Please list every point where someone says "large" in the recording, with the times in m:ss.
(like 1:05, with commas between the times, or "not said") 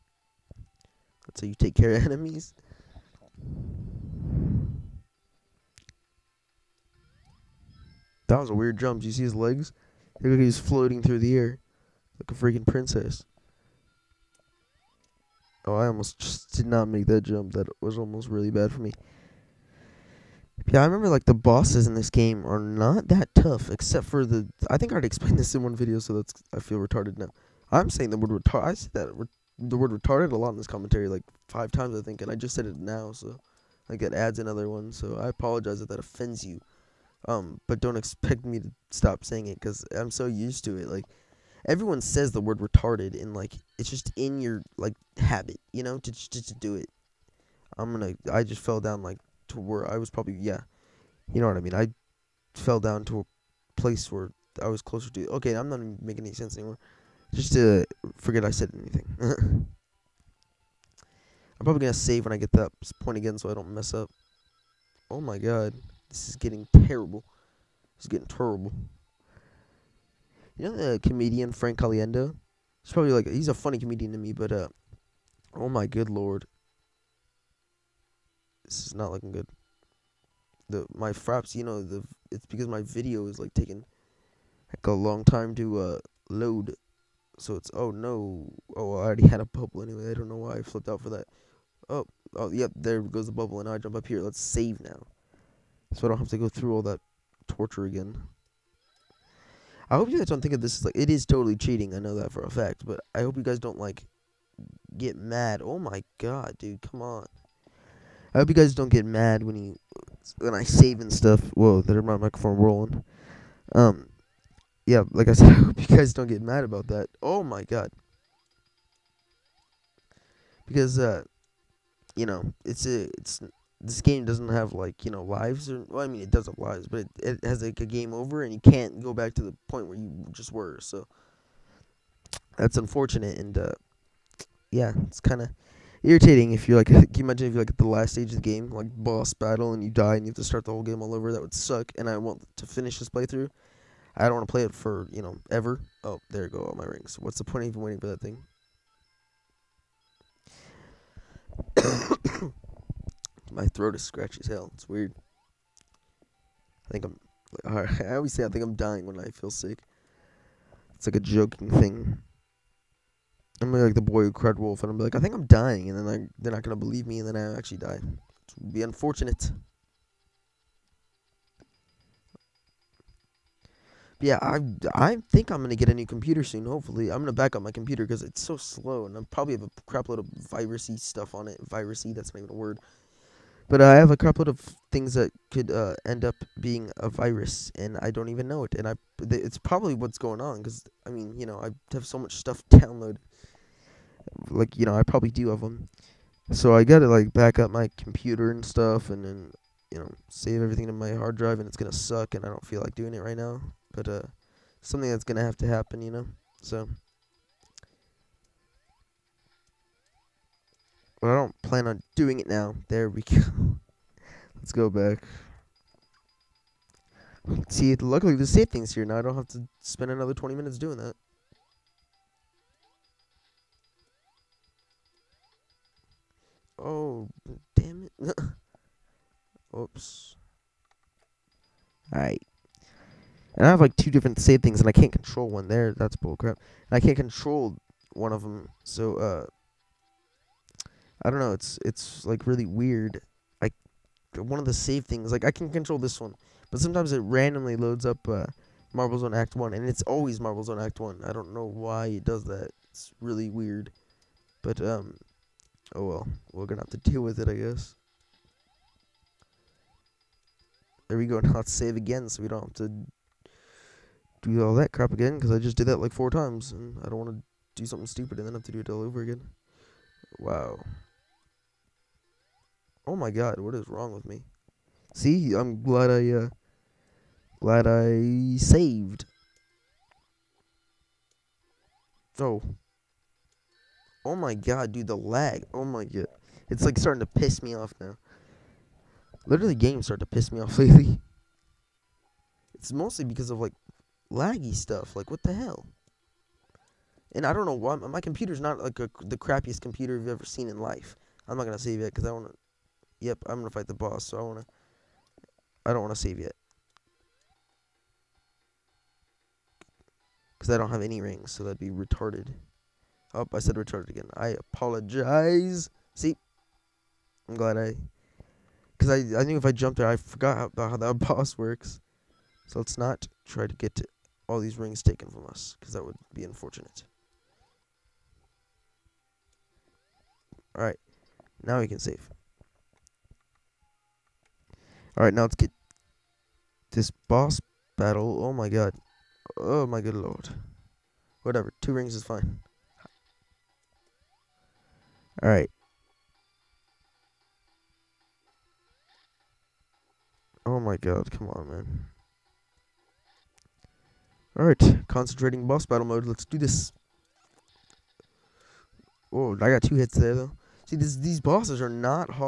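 not said.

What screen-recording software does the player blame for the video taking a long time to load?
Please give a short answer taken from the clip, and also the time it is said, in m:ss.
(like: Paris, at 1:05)
fraps, at 1:21.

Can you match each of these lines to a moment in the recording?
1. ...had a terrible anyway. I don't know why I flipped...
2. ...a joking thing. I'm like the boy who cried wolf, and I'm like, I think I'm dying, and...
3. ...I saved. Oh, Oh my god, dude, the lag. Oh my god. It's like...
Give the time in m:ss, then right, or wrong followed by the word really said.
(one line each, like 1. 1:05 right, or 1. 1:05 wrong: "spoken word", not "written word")
1. 1:29 wrong: "bubble", not "terrible"
2. 2:41 right
3. 4:37 right.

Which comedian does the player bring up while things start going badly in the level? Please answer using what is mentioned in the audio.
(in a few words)
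Frank Caliendo.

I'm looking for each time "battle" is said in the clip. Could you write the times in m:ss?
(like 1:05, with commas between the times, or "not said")
2:19, 5:37, 5:55.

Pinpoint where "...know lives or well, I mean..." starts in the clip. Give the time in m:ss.
2:05.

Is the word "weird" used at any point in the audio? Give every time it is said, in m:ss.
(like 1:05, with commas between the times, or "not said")
0:08, 2:34, 4:02, 4:13.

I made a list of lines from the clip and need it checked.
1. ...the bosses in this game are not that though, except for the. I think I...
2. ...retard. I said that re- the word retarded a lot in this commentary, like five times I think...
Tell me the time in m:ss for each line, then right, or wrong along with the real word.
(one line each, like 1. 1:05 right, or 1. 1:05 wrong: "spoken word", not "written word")
1. 0:21 wrong: "tough", not "though"
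2. 0:28 right.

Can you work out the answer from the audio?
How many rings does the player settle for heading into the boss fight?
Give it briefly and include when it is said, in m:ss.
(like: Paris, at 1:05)
2, at 5:41.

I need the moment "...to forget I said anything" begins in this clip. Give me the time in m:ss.
0:57.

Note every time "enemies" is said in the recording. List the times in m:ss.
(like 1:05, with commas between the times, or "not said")
0:02.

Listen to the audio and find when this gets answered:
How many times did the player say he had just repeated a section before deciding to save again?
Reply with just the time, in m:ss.
4:26.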